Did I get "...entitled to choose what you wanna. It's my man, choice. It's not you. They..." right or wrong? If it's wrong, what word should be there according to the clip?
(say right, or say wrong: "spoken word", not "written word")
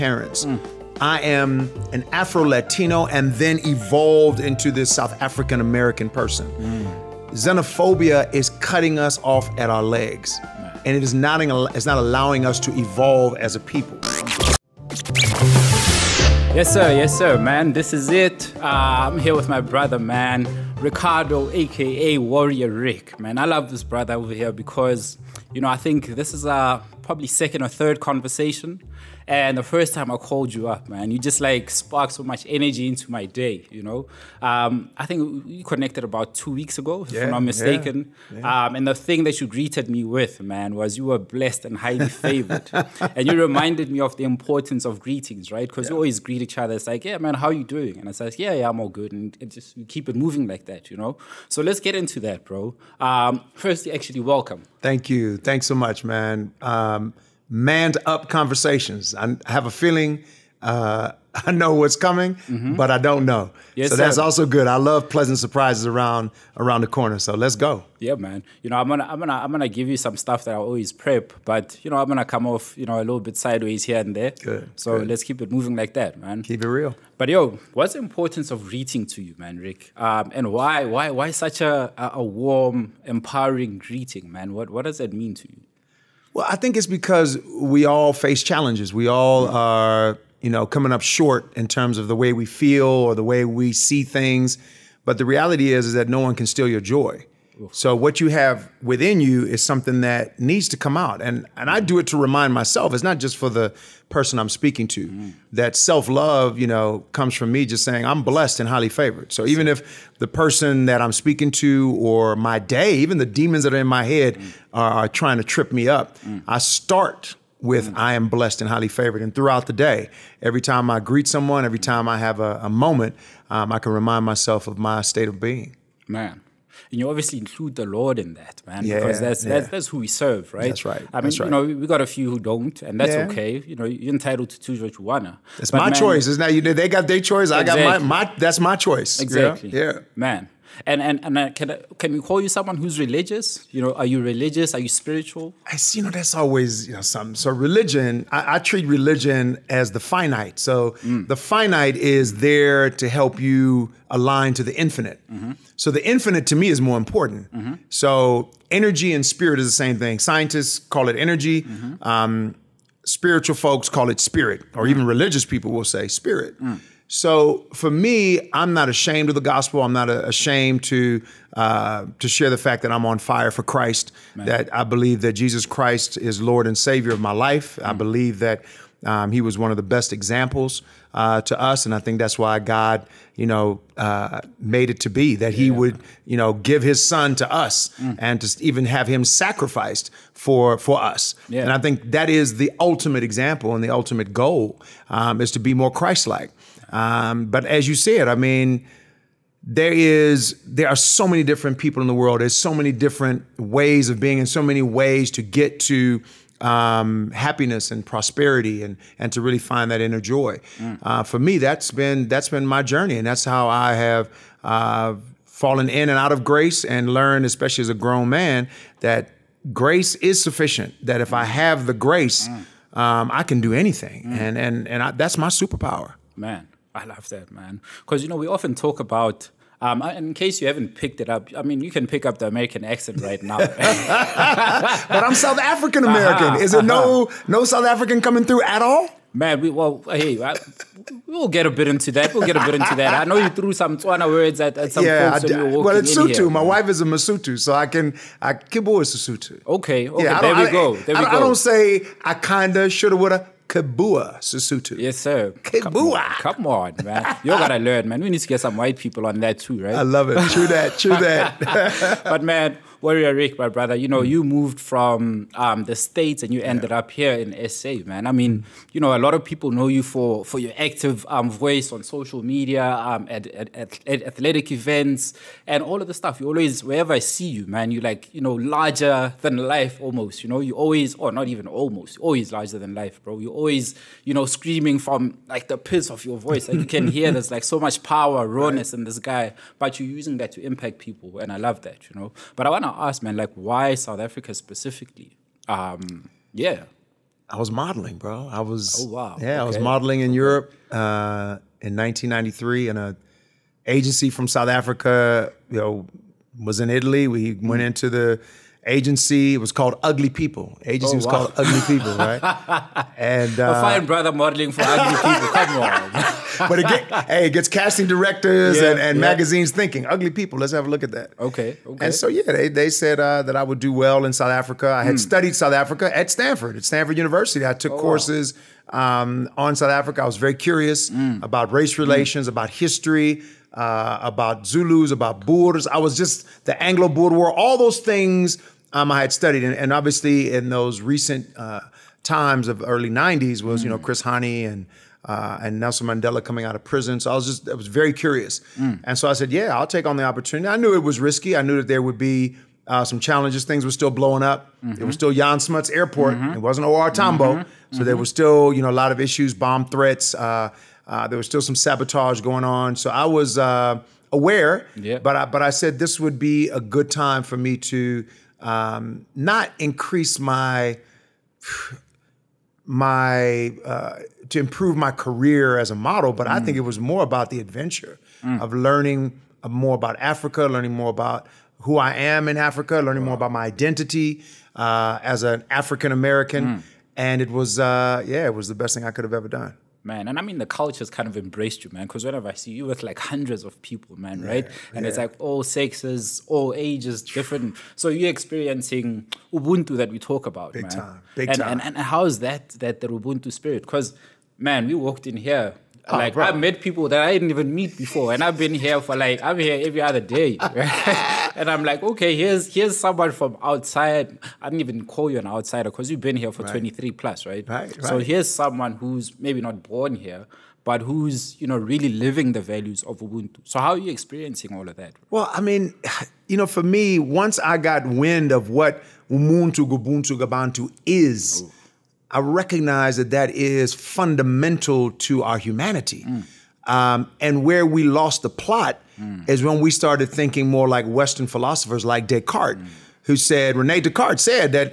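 right.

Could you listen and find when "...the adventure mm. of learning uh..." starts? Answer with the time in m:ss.
6:17.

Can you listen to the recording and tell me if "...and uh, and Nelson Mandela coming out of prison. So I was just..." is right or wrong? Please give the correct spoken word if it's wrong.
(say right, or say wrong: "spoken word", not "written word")
right.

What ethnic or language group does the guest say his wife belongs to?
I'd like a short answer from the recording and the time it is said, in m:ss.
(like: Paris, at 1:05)
Mosotho, at 4:06.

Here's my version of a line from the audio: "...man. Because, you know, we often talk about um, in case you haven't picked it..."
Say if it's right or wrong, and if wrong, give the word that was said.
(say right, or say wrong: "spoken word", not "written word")
right.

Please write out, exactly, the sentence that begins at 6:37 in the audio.
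So you're experiencing Ubuntu that we talk about, Big man.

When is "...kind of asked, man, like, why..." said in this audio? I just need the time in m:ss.
4:52.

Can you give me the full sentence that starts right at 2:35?
So the infinite to me is more important.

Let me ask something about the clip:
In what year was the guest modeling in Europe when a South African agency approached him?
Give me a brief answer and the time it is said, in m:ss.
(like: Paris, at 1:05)
1993, at 5:01.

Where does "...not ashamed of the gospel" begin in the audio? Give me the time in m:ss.
2:48.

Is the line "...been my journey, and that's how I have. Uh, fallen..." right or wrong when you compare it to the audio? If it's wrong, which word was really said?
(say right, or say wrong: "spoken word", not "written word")
right.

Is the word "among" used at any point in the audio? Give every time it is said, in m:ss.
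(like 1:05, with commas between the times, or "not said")
not said.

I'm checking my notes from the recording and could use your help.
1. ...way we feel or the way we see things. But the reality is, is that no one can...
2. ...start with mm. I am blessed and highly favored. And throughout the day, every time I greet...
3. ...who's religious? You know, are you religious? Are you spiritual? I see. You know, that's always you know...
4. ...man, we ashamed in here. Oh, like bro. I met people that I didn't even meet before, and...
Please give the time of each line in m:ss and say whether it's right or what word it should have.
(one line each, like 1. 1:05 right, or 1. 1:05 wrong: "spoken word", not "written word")
1. 1:32 right
2. 1:56 right
3. 2:22 right
4. 6:44 wrong: "walked", not "ashamed".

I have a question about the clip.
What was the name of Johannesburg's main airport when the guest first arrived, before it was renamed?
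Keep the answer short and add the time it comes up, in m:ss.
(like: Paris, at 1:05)
Jan Smuts Airport, at 5:55.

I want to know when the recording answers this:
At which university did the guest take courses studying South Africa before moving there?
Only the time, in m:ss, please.
5:26.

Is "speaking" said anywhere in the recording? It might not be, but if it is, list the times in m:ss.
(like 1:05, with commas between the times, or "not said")
1:44, 1:51.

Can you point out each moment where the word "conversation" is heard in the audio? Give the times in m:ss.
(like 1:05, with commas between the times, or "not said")
0:27, 0:58.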